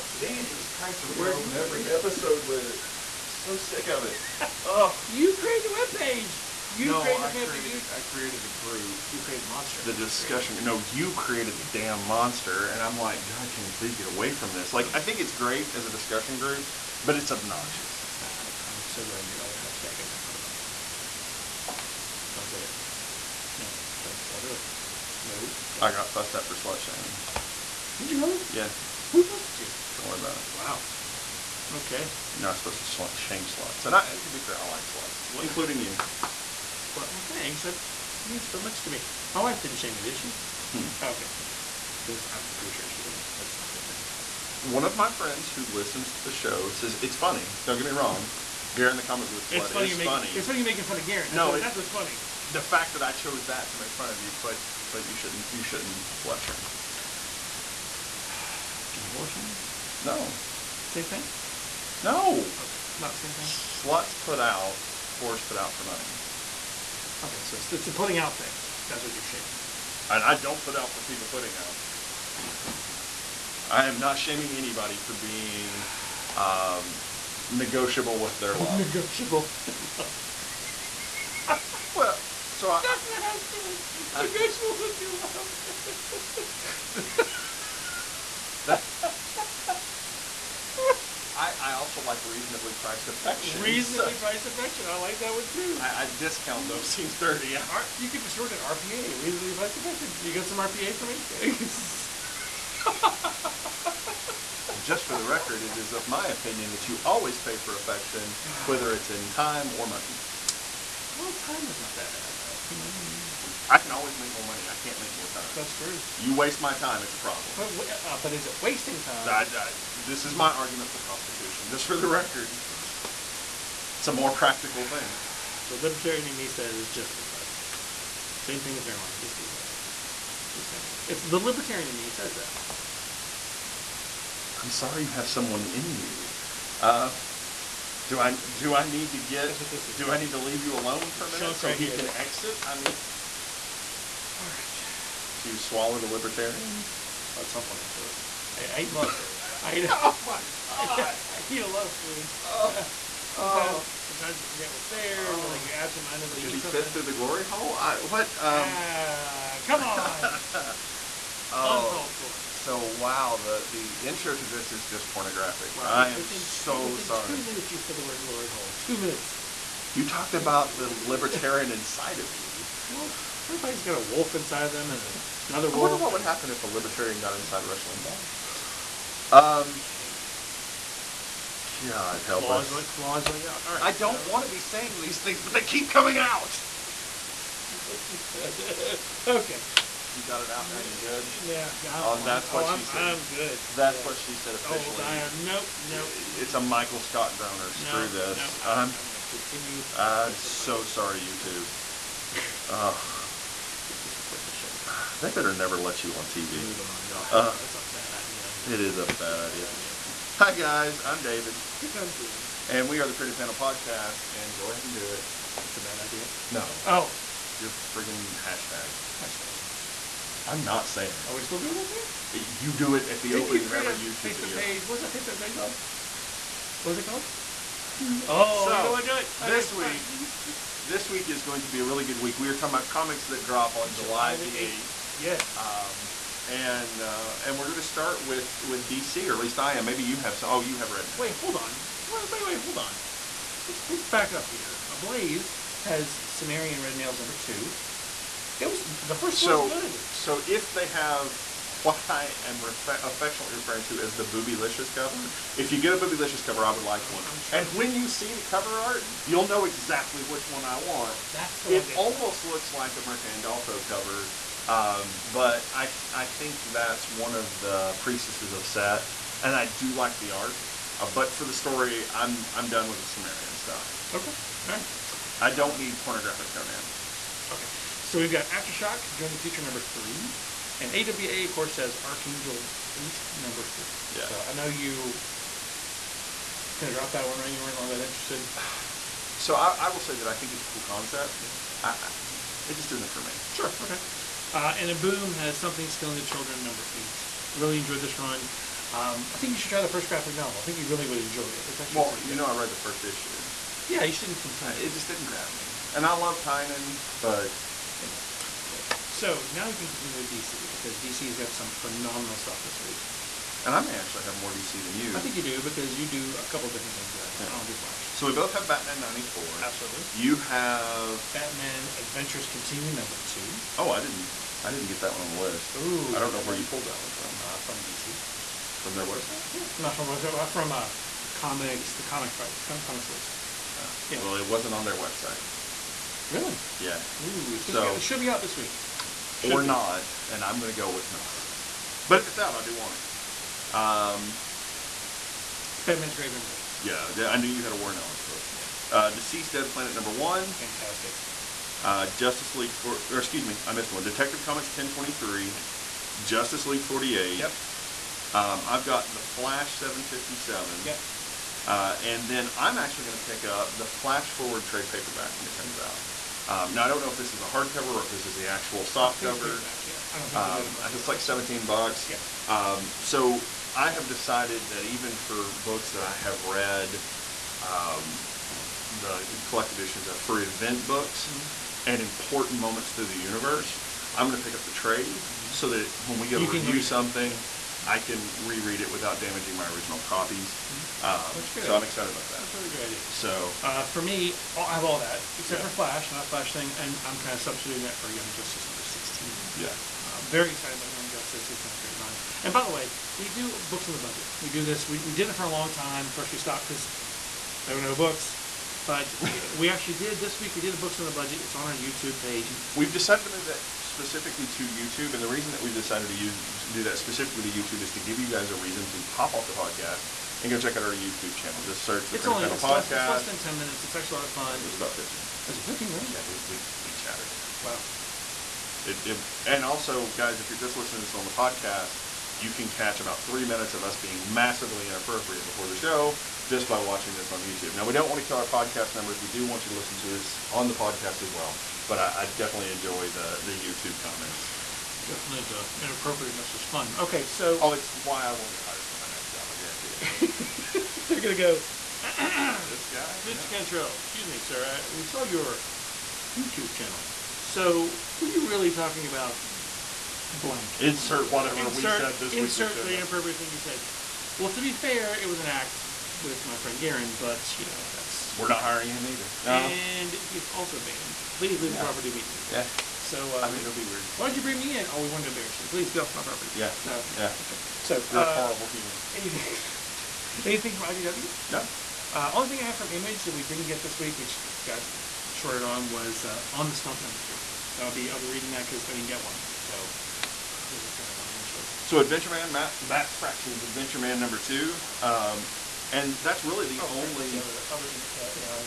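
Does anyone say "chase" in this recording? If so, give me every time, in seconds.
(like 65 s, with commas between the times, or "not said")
not said.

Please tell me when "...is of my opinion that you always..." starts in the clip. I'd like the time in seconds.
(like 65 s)
105 s.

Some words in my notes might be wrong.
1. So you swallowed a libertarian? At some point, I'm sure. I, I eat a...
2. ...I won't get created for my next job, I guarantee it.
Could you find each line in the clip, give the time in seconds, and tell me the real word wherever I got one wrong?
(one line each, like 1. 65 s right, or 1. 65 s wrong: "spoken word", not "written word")
1. 145 s right
2. 448 s wrong: "hired", not "created".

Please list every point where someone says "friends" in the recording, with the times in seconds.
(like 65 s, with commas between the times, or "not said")
45 s, 466 s.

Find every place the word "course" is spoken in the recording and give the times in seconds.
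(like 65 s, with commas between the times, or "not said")
281 s, 406 s.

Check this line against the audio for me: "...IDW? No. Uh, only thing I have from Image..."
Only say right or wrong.
right.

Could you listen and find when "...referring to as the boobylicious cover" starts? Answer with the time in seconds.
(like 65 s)
253 s.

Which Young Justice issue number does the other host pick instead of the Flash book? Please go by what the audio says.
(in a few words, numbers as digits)
16.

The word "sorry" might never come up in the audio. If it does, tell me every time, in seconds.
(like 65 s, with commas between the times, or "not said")
134 s, 167 s, 200 s, 497 s.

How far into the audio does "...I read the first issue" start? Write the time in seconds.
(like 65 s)
302 s.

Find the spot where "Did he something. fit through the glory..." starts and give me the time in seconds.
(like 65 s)
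156 s.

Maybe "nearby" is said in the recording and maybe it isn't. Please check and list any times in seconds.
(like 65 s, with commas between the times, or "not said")
not said.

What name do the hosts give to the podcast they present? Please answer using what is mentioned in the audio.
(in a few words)
Pretty Panel Podcast.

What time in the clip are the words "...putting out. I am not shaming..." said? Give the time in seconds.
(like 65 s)
71 s.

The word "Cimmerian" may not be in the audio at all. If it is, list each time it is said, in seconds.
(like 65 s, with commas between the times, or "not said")
246 s, 273 s.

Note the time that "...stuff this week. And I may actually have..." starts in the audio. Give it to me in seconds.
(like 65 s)
312 s.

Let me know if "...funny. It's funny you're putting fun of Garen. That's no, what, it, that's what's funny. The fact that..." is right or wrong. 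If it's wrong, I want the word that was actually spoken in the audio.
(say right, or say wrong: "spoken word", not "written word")
wrong: "making", not "putting".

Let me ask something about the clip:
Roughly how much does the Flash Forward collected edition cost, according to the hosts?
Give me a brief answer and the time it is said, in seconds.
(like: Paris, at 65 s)
17 dollars, at 371 s.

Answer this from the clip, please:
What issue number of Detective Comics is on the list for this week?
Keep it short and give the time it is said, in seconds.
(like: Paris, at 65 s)
1023, at 354 s.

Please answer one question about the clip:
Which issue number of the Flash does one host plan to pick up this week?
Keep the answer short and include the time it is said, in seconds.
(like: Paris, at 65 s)
757, at 359 s.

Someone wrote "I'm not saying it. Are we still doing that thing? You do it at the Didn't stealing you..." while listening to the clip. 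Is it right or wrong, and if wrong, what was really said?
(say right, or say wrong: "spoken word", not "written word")
wrong: "opening", not "stealing".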